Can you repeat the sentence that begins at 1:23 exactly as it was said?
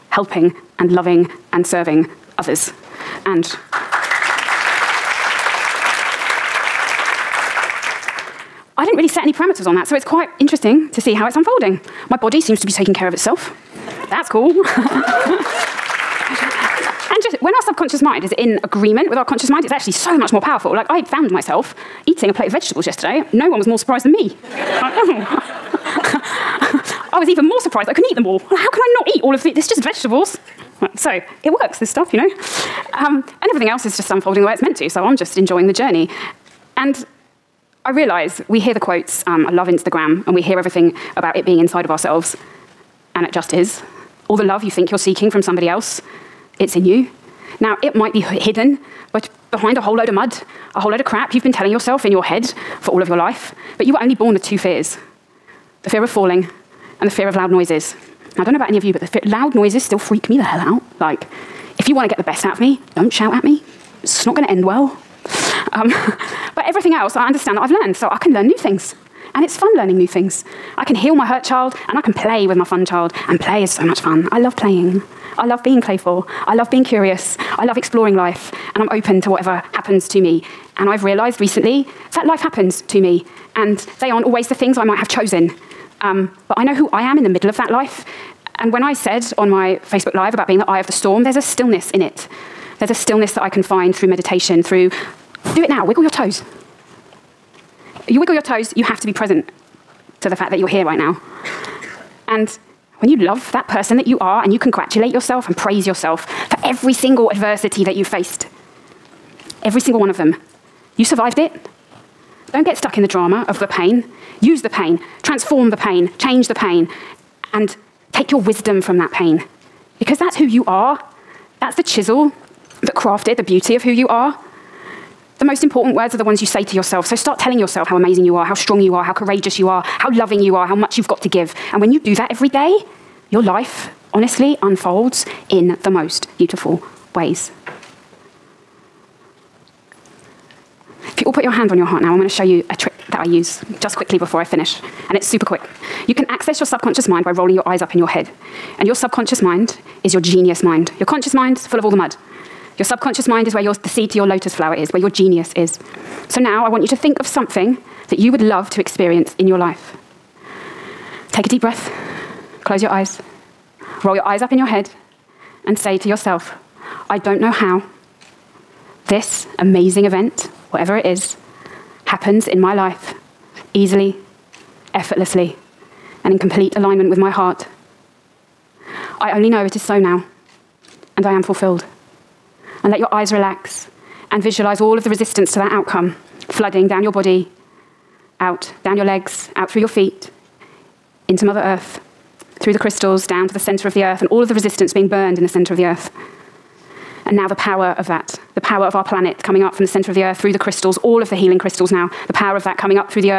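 And they aren't always the things I might have chosen.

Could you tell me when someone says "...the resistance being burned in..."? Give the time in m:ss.
3:14.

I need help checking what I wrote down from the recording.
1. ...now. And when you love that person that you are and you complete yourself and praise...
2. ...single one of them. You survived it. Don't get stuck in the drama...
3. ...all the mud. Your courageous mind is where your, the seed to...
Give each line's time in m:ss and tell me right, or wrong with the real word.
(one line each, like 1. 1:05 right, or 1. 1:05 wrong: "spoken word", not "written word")
1. 1:40 wrong: "congratulate", not "complete"
2. 1:49 right
3. 2:31 wrong: "subconscious", not "courageous".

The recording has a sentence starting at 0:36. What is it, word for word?
And I realize we hear the quotes.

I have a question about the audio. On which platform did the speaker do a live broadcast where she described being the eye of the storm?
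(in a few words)
Facebook Live.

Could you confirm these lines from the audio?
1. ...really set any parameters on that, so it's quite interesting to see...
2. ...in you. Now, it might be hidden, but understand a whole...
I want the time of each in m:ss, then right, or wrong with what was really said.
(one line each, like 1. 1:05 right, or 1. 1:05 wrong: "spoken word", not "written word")
1. 0:08 right
2. 0:46 wrong: "behind", not "understand".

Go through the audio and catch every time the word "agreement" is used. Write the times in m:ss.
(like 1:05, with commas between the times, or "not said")
0:18.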